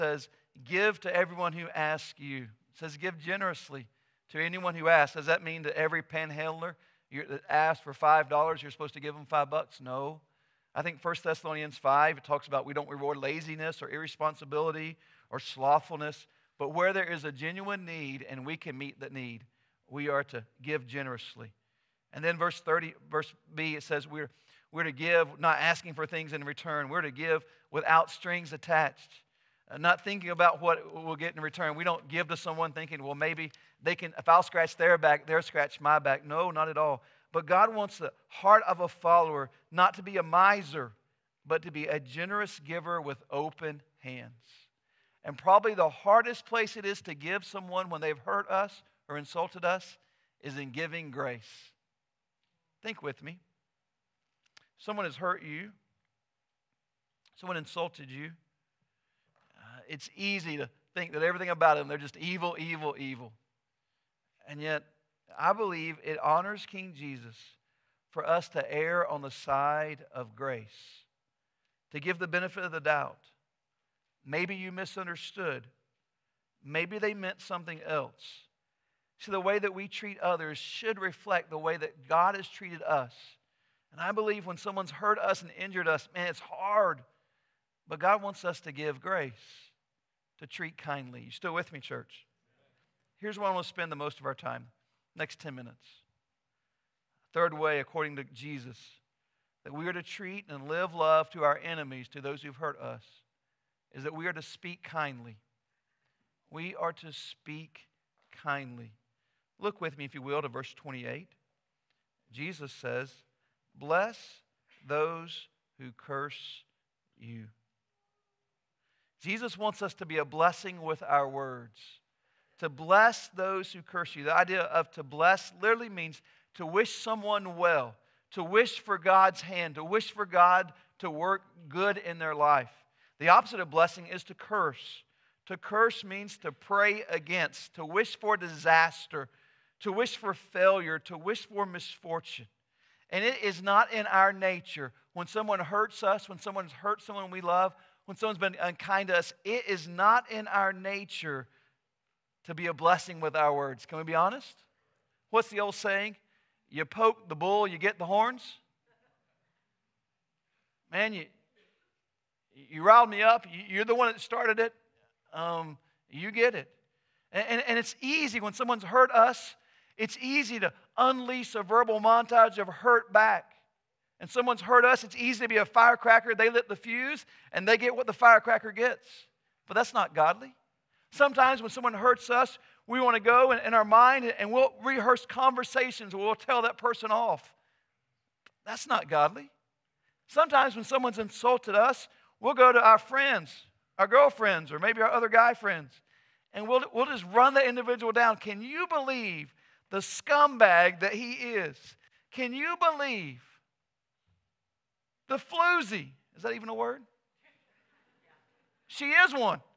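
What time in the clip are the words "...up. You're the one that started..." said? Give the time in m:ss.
2:43.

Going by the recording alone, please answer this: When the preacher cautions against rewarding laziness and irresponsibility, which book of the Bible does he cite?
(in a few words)
1 Thessalonians 5.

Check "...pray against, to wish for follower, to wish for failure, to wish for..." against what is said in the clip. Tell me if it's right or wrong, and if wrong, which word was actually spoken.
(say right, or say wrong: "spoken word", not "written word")
wrong: "disaster", not "follower".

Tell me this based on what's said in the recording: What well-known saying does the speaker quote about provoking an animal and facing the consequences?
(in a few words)
You poke the bull, you get the horns.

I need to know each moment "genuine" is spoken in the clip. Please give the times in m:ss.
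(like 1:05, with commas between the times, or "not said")
0:17.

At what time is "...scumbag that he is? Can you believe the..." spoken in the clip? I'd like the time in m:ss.
3:19.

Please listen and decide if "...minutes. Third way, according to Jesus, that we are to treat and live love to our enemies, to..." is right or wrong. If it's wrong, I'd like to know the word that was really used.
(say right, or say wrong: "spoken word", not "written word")
right.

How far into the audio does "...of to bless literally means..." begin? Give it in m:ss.
2:04.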